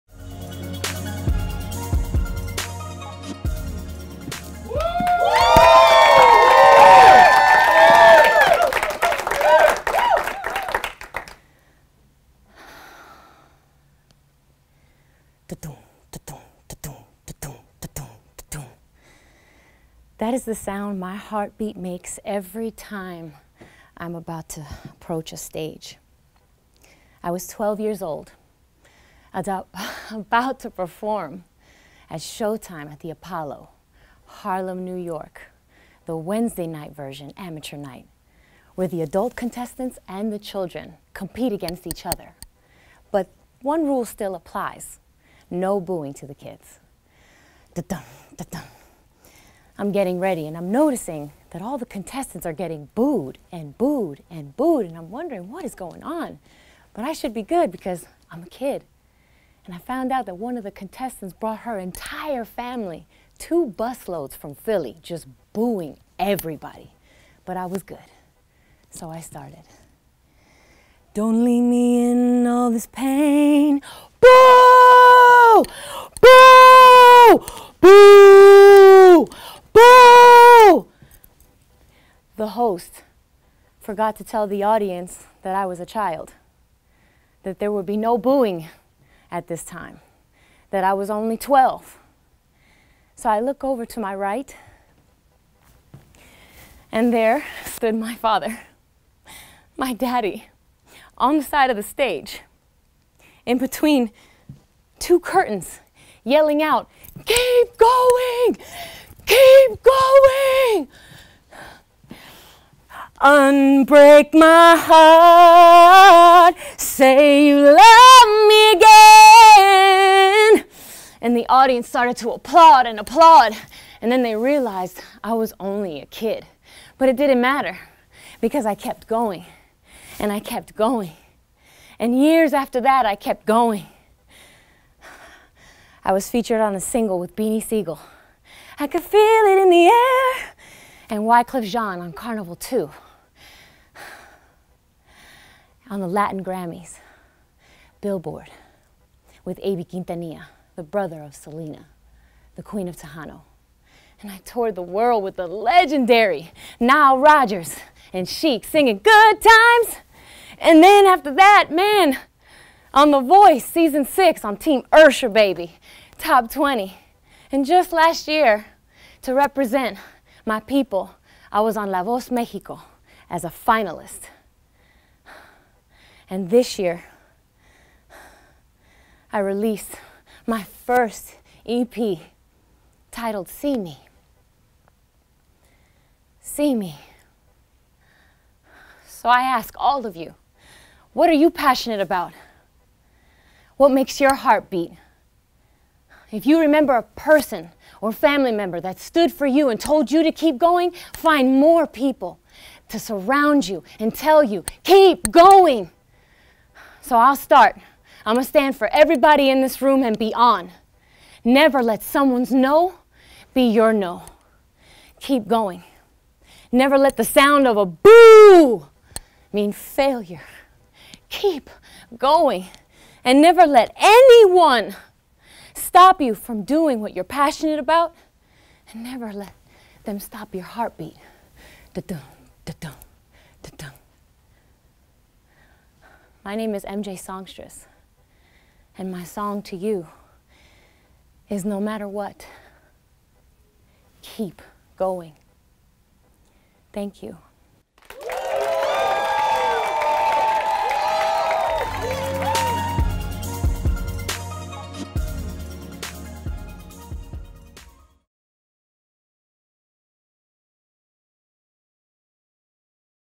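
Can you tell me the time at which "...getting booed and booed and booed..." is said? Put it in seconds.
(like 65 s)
52 s.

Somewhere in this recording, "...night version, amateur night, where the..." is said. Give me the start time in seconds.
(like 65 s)
36 s.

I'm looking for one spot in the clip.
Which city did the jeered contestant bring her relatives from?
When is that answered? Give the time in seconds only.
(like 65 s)
64 s.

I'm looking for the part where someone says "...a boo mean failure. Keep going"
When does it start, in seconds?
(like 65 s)
217 s.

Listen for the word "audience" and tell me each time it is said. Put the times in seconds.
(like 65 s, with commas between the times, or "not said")
84 s, 121 s.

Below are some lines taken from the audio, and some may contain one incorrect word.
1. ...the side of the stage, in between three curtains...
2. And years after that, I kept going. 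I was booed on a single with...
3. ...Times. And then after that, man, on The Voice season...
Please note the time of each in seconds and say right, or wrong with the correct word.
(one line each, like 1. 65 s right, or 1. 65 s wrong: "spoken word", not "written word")
1. 101 s wrong: "two", not "three"
2. 131 s wrong: "featured", not "booed"
3. 159 s right.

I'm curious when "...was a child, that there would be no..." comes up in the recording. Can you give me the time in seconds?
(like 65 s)
85 s.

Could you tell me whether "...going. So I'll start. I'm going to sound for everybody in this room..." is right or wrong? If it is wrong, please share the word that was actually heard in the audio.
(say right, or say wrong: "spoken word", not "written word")
wrong: "stand", not "sound".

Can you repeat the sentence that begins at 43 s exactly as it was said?
But one rule still applies, no booing to the kids.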